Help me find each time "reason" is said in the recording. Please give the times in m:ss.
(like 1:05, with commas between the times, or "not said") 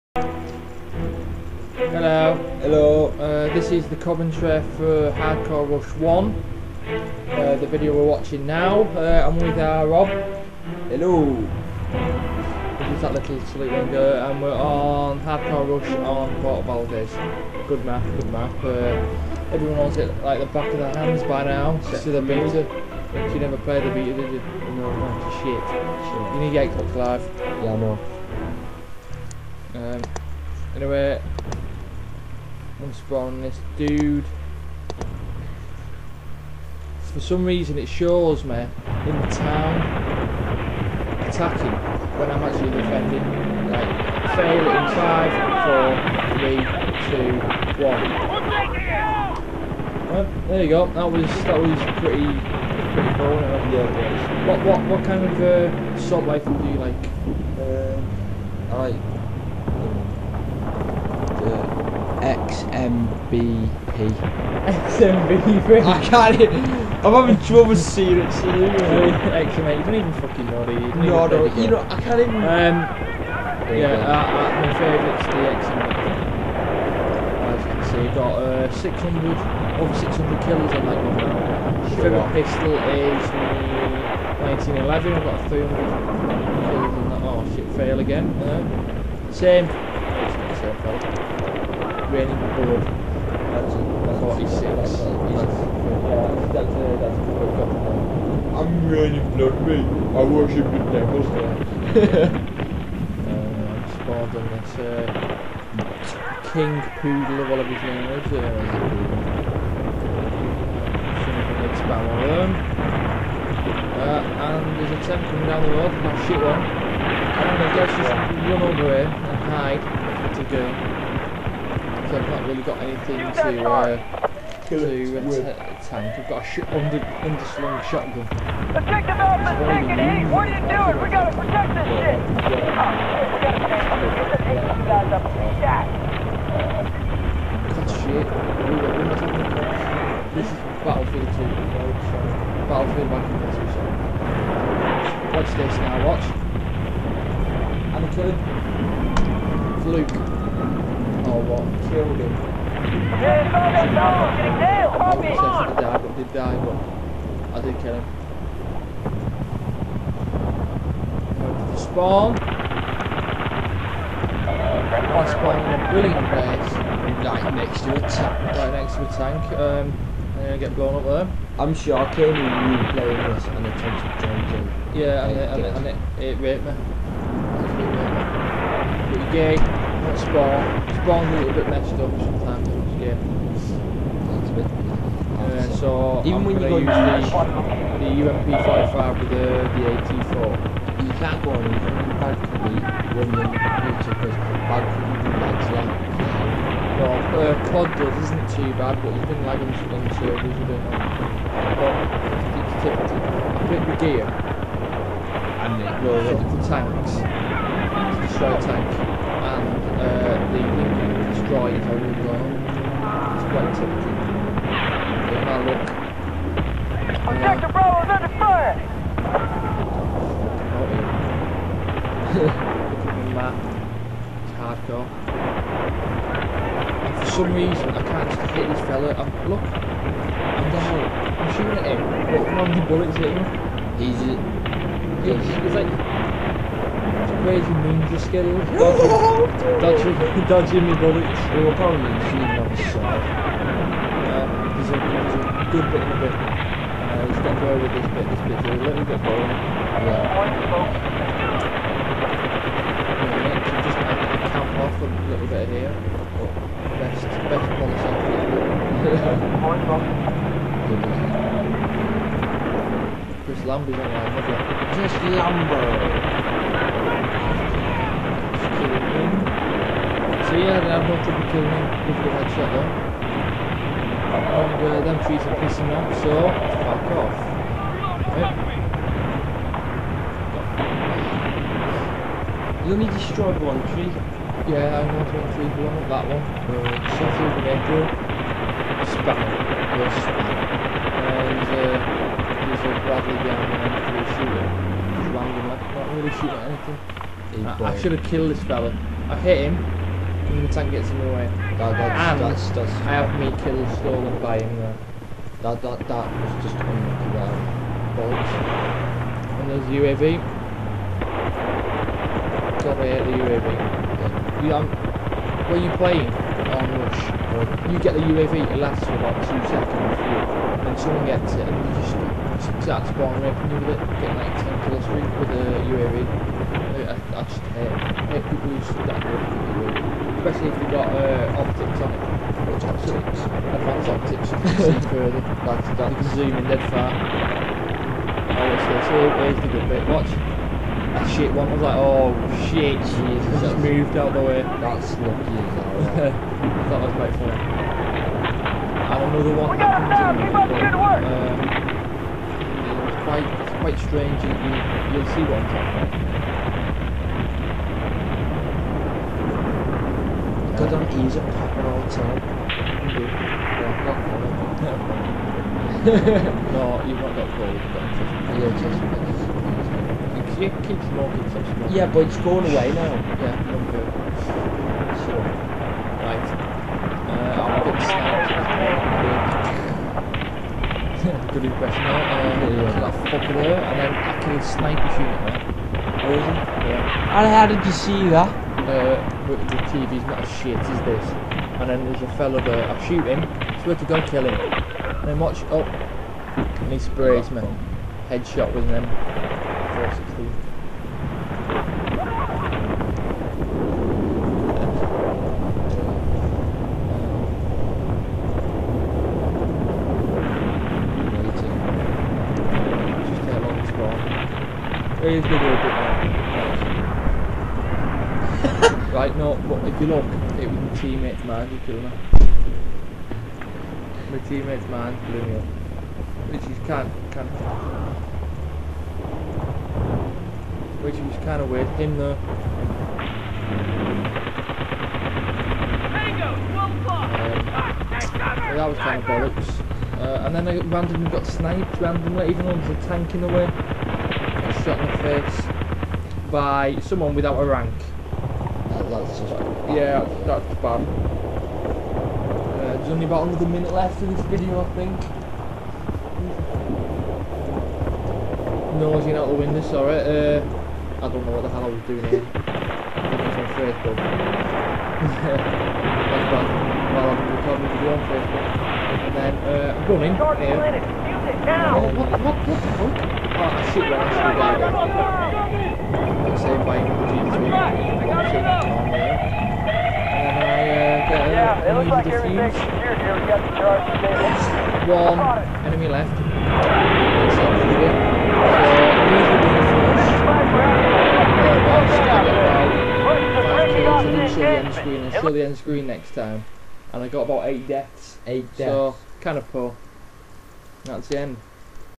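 0:37, 3:47.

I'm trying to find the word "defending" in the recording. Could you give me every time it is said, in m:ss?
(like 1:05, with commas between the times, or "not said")
0:42.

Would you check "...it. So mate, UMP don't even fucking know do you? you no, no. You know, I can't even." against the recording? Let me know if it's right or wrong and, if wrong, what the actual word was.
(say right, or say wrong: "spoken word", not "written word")
wrong: "You", not "UMP".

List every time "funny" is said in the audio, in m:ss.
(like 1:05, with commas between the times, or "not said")
5:47.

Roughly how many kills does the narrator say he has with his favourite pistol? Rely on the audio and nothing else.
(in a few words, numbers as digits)
300.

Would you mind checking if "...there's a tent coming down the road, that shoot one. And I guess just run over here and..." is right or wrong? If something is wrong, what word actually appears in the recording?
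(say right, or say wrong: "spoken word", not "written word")
right.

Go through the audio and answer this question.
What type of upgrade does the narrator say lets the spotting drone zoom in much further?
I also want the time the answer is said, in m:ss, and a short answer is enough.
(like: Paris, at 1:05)
Advanced optics, at 5:33.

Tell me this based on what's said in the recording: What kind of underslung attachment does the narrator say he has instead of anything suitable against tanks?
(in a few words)
shotgun.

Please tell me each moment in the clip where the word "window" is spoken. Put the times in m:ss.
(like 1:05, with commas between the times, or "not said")
0:13, 7:39.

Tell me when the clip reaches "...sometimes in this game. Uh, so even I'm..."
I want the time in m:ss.
3:02.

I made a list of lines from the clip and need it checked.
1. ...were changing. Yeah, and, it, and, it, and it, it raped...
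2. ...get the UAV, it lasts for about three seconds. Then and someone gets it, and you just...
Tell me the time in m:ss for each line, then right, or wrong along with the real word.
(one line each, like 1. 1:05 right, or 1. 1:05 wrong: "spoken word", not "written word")
1. 2:54 right
2. 5:17 wrong: "two", not "three".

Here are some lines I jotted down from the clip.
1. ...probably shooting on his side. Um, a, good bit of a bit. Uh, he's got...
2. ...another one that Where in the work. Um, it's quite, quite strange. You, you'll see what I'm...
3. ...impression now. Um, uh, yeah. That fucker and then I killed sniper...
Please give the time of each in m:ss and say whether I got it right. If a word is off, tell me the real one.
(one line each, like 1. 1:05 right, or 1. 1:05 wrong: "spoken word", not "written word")
1. 4:01 right
2. 5:49 wrong: "Keep", not "Where"
3. 6:21 right.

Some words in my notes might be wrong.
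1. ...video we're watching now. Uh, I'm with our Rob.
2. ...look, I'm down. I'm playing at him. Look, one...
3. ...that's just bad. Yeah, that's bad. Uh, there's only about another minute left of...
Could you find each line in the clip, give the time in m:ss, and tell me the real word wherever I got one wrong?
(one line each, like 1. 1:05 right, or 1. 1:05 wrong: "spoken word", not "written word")
1. 0:07 right
2. 3:49 wrong: "shooting", not "playing"
3. 7:29 right.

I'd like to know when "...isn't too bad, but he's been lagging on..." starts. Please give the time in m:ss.
3:18.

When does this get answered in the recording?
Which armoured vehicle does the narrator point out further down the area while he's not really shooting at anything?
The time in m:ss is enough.
4:53.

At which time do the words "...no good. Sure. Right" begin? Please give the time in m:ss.
6:13.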